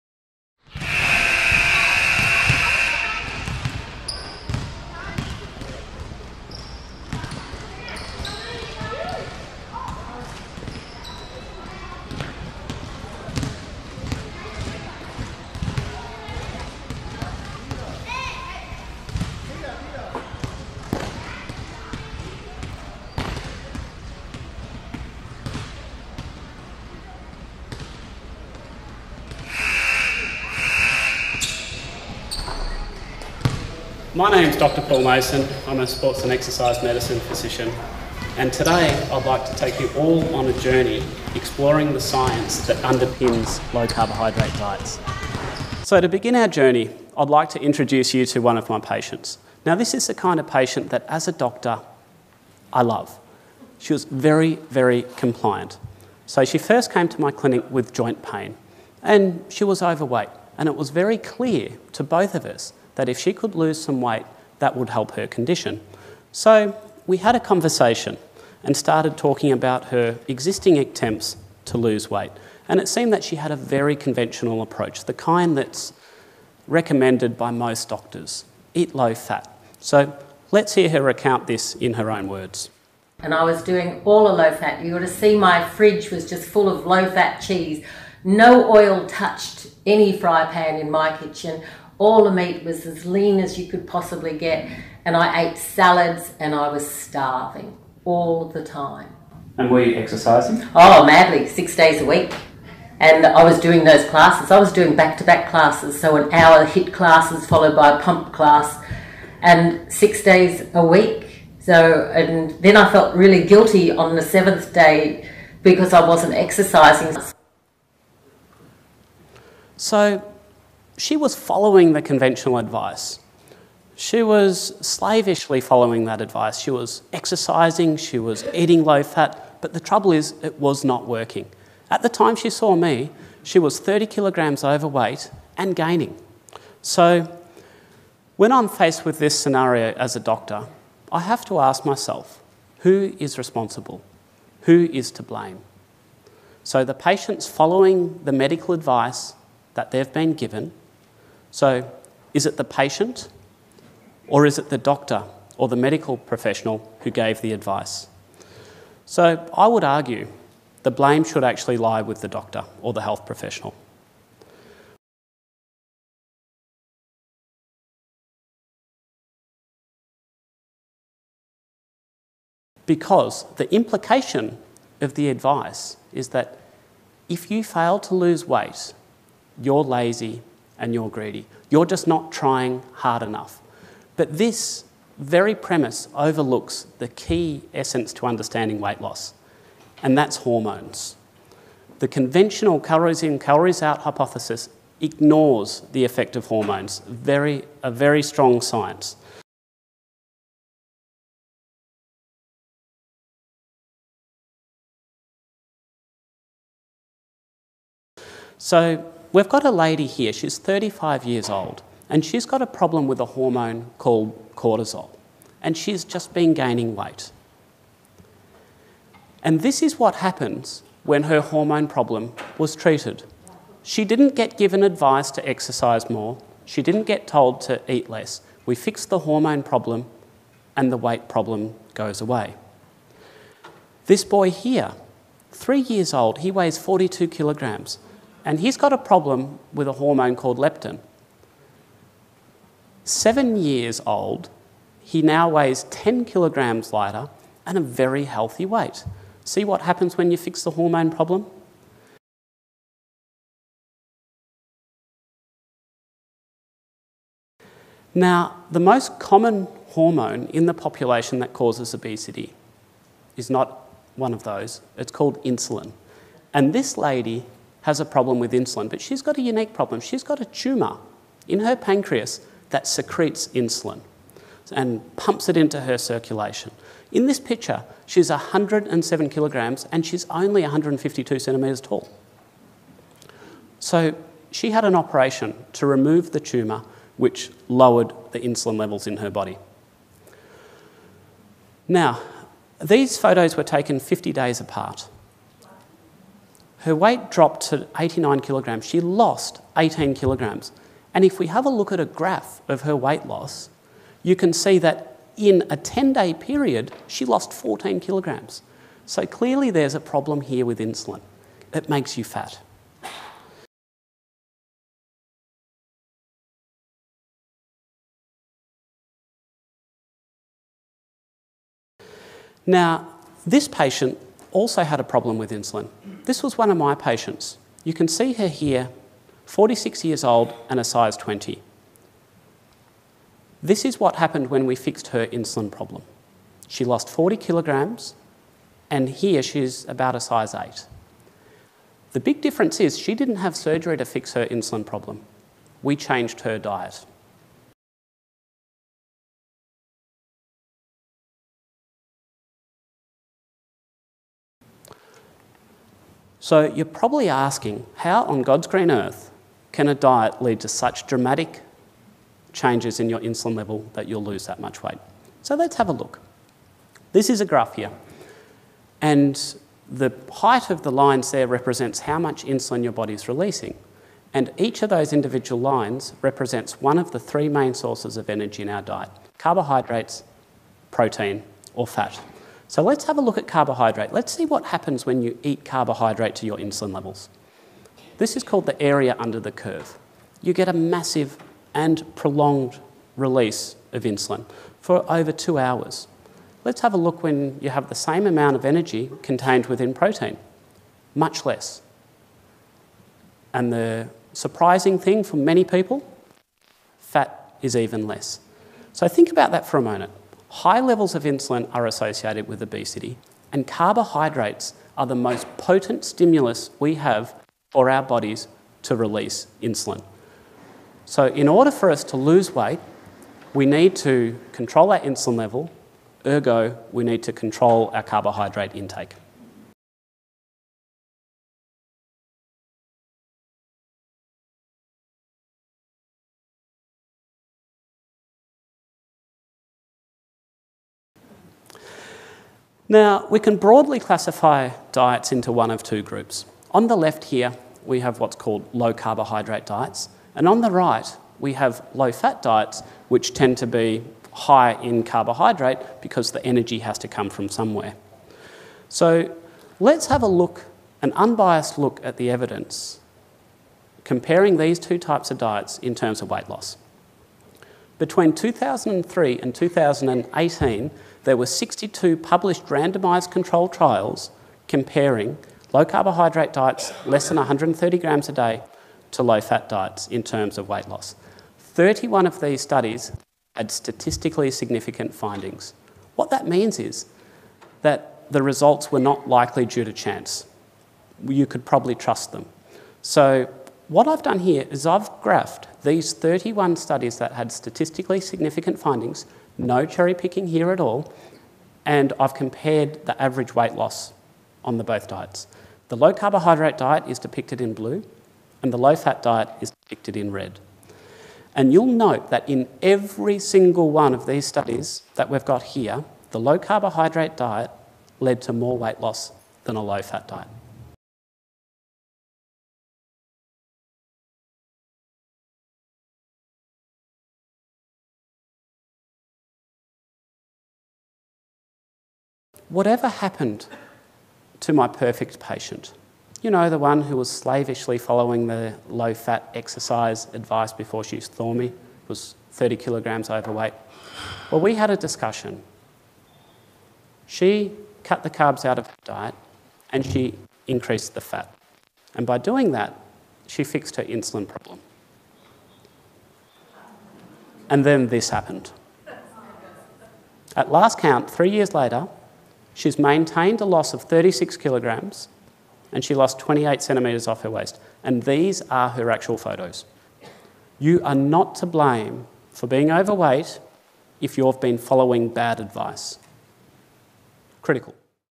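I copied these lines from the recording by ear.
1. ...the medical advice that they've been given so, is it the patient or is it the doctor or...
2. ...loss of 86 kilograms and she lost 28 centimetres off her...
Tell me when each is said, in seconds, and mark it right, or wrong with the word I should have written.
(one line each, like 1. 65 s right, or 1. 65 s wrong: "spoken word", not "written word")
1. 148 s right
2. 563 s wrong: "36", not "86".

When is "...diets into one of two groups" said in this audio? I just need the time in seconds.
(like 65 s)
444 s.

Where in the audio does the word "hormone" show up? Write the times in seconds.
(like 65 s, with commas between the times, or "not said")
190 s, 196 s, 213 s, 221 s, 229 s, 239 s, 250 s, 259 s.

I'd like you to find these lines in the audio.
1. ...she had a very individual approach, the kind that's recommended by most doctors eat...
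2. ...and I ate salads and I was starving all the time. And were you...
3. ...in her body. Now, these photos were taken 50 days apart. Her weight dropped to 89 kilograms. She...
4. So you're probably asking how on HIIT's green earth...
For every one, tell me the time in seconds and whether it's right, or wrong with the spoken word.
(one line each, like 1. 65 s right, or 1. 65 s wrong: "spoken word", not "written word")
1. 73 s wrong: "conventional", not "individual"
2. 95 s right
3. 289 s right
4. 356 s wrong: "God", not "HIIT".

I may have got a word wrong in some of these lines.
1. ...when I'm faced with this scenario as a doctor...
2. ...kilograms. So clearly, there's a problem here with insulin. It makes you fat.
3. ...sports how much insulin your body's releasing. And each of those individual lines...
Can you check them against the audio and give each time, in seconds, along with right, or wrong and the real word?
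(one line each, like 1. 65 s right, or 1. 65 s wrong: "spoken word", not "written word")
1. 138 s right
2. 307 s right
3. 371 s wrong: "represents", not "sports".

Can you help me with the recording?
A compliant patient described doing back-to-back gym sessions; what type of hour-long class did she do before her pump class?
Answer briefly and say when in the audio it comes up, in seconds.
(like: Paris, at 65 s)
HIIT, at 106 s.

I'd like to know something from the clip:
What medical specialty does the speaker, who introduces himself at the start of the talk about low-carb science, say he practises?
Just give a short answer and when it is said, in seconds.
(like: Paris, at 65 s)
Sports and exercise medicine, at 35 s.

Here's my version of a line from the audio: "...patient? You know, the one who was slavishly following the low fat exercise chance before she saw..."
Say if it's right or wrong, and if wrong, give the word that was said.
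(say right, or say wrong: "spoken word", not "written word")
wrong: "advice", not "chance".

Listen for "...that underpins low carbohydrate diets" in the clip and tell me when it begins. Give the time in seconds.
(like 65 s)
42 s.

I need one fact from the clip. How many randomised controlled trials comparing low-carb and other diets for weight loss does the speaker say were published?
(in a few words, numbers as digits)
62.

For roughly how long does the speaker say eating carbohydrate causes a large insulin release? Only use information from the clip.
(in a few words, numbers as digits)
Over 2 hours.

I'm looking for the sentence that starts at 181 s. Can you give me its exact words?
You're just not trying hard enough.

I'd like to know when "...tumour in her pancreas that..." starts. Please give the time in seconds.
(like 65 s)
270 s.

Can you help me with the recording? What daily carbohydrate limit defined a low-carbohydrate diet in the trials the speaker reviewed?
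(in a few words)
130 grams.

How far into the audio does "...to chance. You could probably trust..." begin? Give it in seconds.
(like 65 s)
489 s.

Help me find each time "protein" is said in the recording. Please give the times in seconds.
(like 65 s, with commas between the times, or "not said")
380 s, 399 s.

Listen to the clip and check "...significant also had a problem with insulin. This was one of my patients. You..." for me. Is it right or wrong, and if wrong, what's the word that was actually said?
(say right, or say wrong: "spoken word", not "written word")
wrong: "patient", not "significant".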